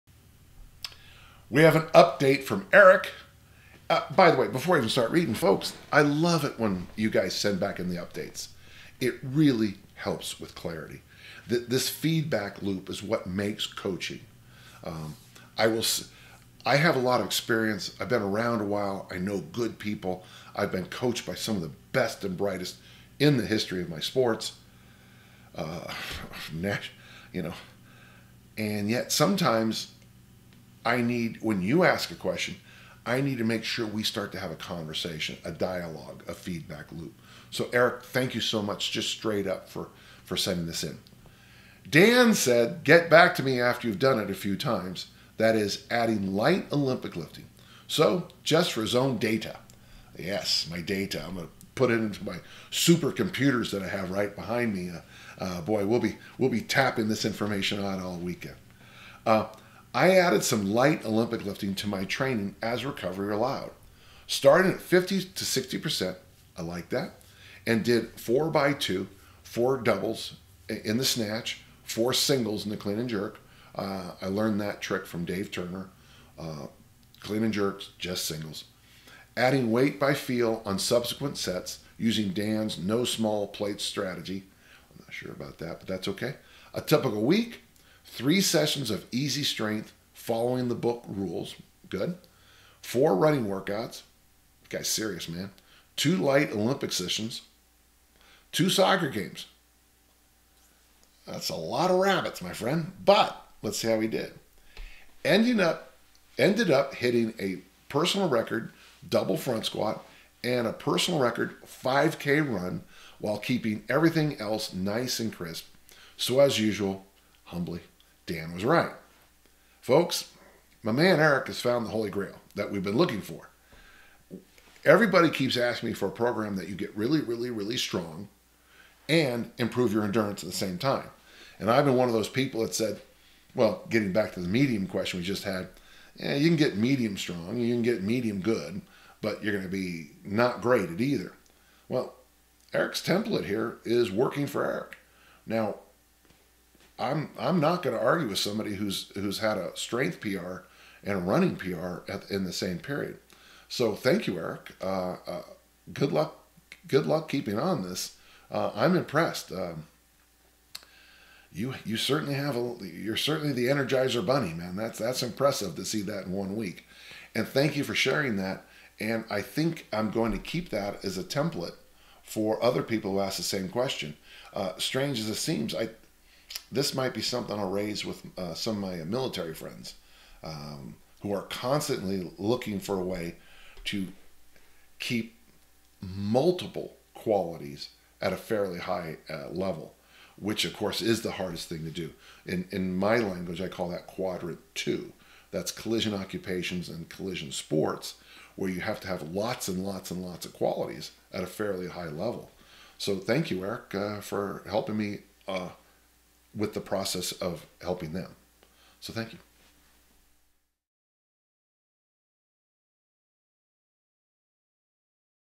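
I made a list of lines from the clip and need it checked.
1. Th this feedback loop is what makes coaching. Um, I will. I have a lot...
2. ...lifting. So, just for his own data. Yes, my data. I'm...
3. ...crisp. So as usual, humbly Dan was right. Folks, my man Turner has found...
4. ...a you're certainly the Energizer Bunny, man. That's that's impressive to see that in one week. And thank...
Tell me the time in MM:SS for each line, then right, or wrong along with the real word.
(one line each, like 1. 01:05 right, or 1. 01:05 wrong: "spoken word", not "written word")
1. 00:11 right
2. 00:47 right
3. 01:55 wrong: "Eric", not "Turner"
4. 02:42 right.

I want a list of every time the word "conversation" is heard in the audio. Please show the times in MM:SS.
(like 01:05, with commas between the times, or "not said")
00:34.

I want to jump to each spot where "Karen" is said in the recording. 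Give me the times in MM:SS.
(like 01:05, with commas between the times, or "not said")
not said.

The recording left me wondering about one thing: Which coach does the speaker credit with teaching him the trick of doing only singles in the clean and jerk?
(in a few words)
Dave Turner.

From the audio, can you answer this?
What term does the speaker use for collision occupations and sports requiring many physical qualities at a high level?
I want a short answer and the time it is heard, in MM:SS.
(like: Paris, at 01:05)
quadrant two, at 03:14.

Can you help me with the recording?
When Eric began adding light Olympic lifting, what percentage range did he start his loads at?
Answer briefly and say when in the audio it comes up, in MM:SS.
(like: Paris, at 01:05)
50 to 60%, at 01:04.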